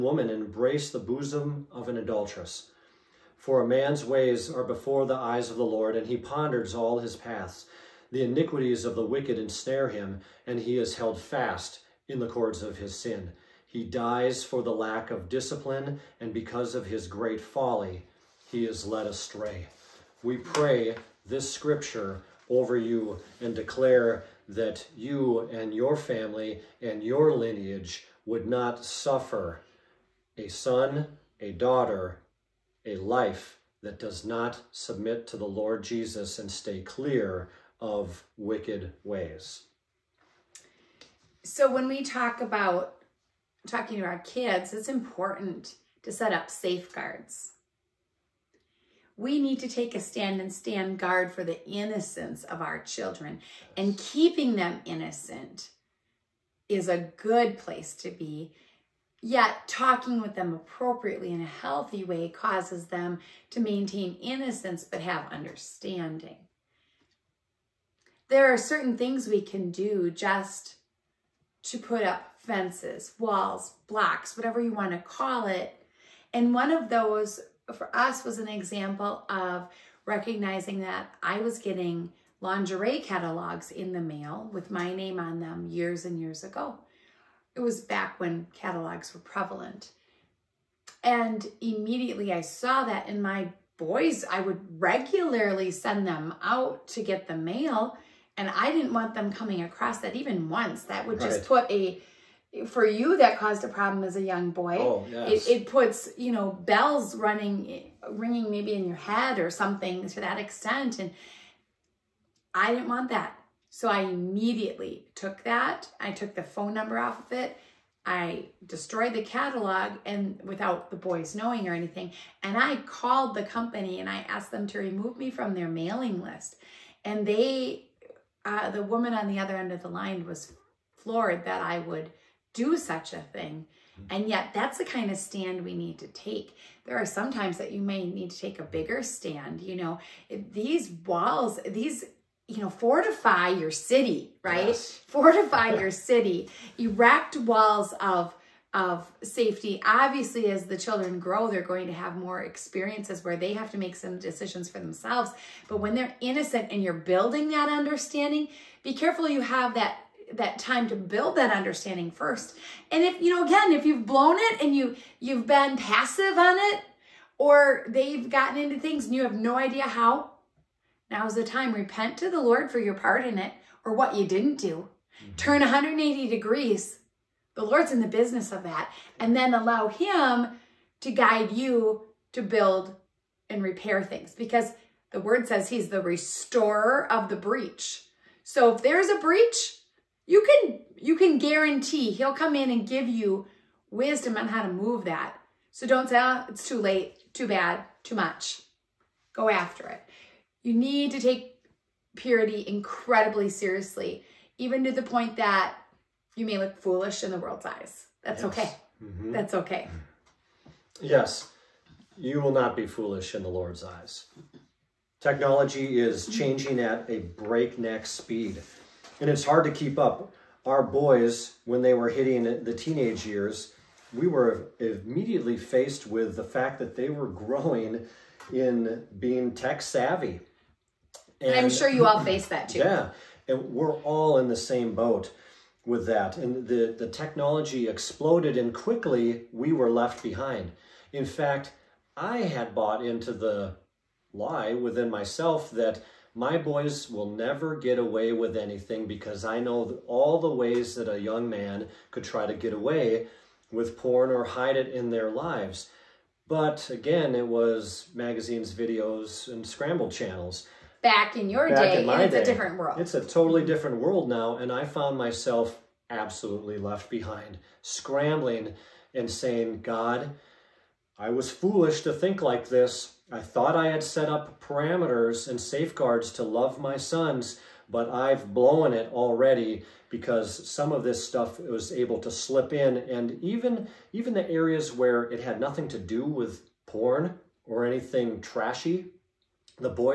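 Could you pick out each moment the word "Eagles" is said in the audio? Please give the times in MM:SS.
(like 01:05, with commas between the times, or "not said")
not said.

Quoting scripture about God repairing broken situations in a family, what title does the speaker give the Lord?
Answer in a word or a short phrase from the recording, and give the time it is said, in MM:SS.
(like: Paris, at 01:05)
The restorer of the breach, at 03:06.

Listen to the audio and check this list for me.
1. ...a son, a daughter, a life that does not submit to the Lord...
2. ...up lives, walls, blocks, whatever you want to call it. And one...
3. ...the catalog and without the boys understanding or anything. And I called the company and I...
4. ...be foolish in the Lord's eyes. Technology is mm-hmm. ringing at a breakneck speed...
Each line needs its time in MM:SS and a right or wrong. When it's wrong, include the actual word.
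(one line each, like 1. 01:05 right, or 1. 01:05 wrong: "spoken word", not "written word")
1. 00:30 right
2. 01:12 wrong: "fences", not "lives"
3. 01:59 wrong: "knowing", not "understanding"
4. 03:32 wrong: "changing", not "ringing".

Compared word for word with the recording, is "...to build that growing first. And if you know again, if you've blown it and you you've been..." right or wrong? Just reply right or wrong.
wrong.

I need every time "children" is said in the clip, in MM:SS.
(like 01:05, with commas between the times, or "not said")
00:52, 02:30.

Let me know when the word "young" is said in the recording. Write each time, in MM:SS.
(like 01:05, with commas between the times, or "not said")
01:44, 04:11.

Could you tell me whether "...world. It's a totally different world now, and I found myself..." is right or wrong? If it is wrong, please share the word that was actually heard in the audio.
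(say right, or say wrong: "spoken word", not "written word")
right.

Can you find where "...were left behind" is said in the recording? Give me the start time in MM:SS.
03:59.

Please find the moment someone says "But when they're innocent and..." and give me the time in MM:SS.
02:35.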